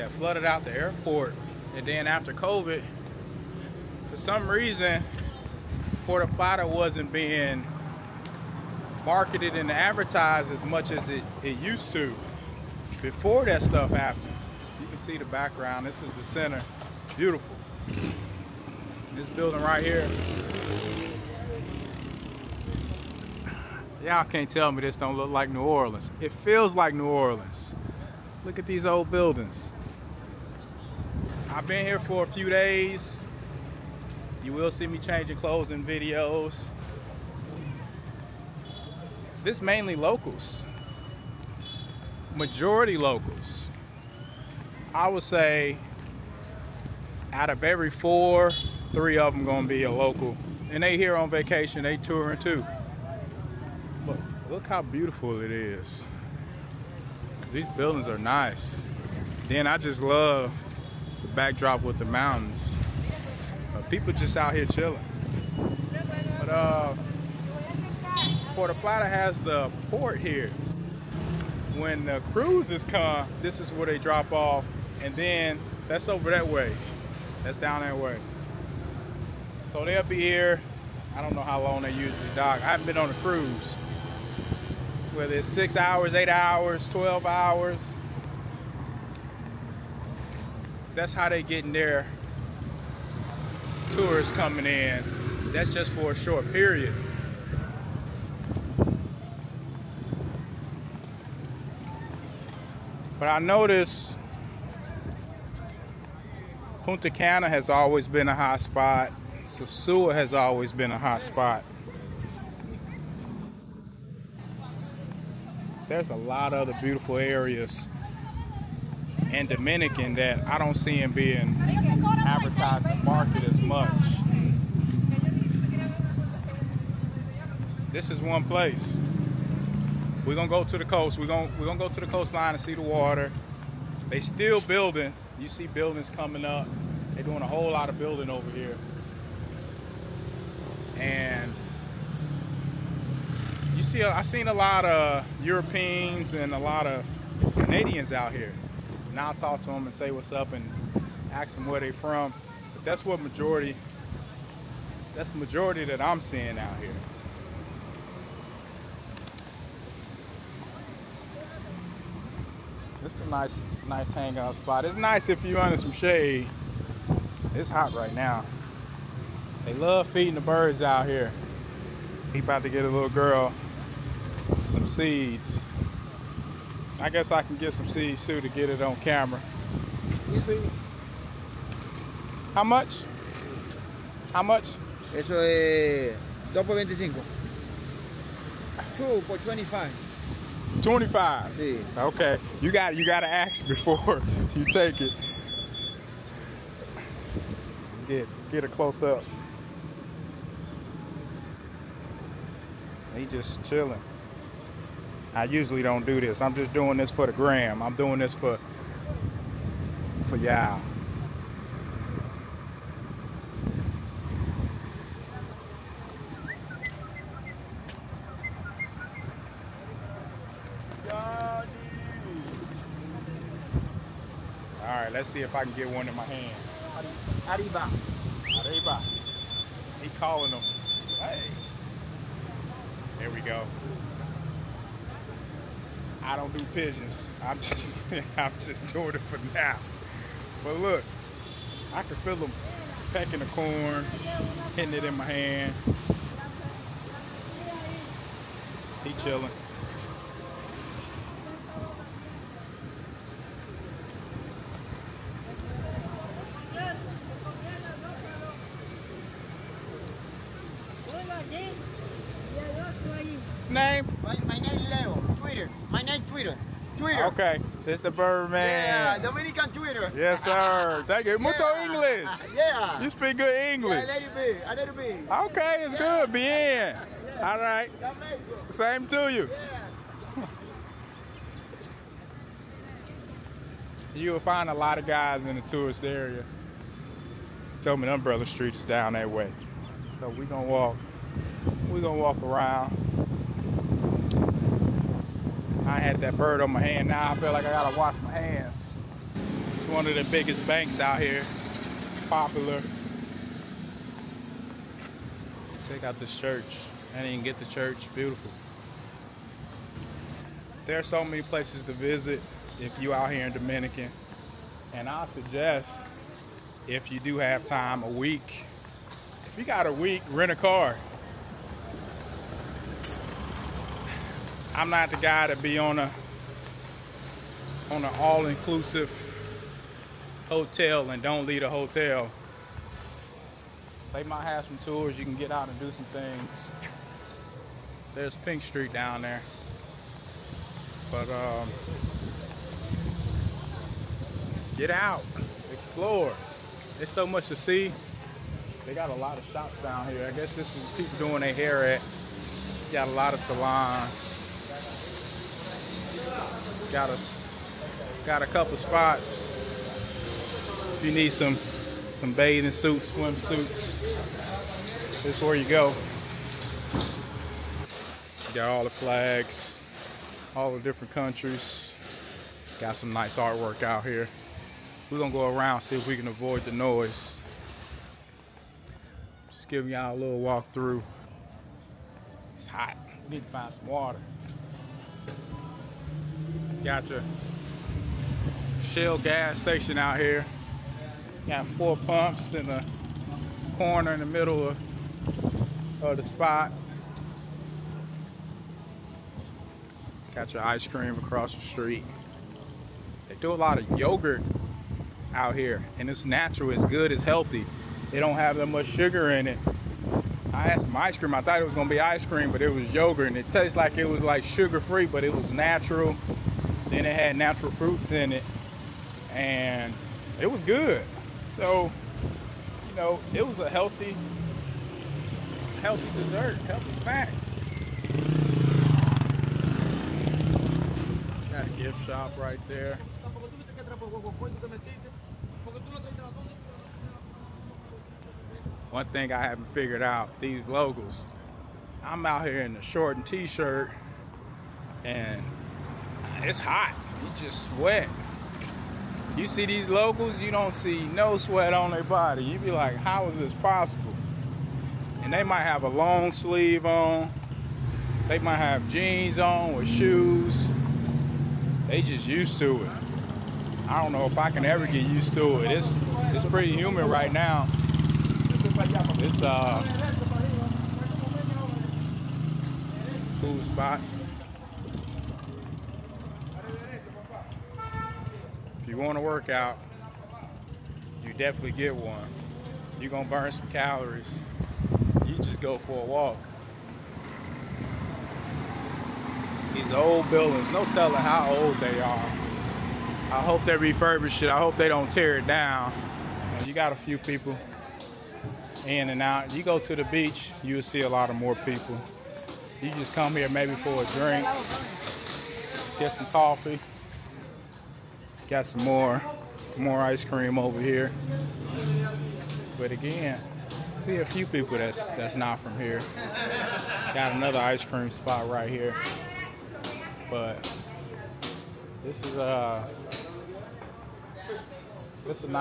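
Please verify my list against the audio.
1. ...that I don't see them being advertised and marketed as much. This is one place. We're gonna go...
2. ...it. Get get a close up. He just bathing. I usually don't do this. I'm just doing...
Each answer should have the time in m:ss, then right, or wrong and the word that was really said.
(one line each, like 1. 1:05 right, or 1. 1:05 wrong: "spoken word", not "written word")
1. 2:00 right
2. 3:15 wrong: "chilling", not "bathing".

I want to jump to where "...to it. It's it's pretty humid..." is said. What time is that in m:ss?
7:45.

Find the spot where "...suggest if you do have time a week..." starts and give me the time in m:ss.
5:15.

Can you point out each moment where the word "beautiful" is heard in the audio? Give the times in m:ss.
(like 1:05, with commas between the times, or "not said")
0:17, 0:54, 1:56, 5:08.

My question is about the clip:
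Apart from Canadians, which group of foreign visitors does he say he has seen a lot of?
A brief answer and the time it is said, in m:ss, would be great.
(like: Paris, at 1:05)
Europeans, at 2:25.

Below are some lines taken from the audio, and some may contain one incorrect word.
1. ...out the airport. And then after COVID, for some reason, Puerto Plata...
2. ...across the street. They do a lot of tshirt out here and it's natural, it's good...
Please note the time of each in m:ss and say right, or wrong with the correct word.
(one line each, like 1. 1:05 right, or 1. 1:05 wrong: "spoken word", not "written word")
1. 0:00 right
2. 6:41 wrong: "yogurt", not "tshirt".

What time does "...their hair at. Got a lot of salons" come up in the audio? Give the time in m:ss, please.
5:51.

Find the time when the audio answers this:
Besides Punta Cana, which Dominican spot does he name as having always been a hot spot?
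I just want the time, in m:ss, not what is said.
1:49.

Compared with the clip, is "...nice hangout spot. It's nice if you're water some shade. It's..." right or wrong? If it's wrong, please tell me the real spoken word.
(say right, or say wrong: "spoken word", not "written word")
wrong: "under", not "water".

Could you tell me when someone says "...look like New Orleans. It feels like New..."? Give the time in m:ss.
0:25.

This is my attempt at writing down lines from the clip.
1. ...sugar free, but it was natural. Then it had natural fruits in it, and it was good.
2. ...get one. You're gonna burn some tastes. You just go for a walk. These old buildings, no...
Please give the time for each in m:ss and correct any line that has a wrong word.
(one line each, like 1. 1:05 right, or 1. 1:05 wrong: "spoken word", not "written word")
1. 6:54 right
2. 8:01 wrong: "calories", not "tastes".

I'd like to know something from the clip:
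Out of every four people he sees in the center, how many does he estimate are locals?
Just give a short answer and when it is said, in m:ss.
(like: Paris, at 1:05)
3, at 0:48.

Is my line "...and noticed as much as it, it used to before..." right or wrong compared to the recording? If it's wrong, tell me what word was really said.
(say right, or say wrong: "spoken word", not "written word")
wrong: "advertised", not "noticed".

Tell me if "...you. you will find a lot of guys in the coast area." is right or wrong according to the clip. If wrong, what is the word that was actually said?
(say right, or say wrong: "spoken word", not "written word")
wrong: "tourist", not "coast".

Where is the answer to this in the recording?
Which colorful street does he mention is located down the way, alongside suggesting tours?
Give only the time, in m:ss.
5:38.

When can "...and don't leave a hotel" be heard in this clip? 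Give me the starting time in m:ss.
5:31.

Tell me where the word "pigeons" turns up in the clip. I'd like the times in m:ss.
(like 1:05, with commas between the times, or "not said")
3:56.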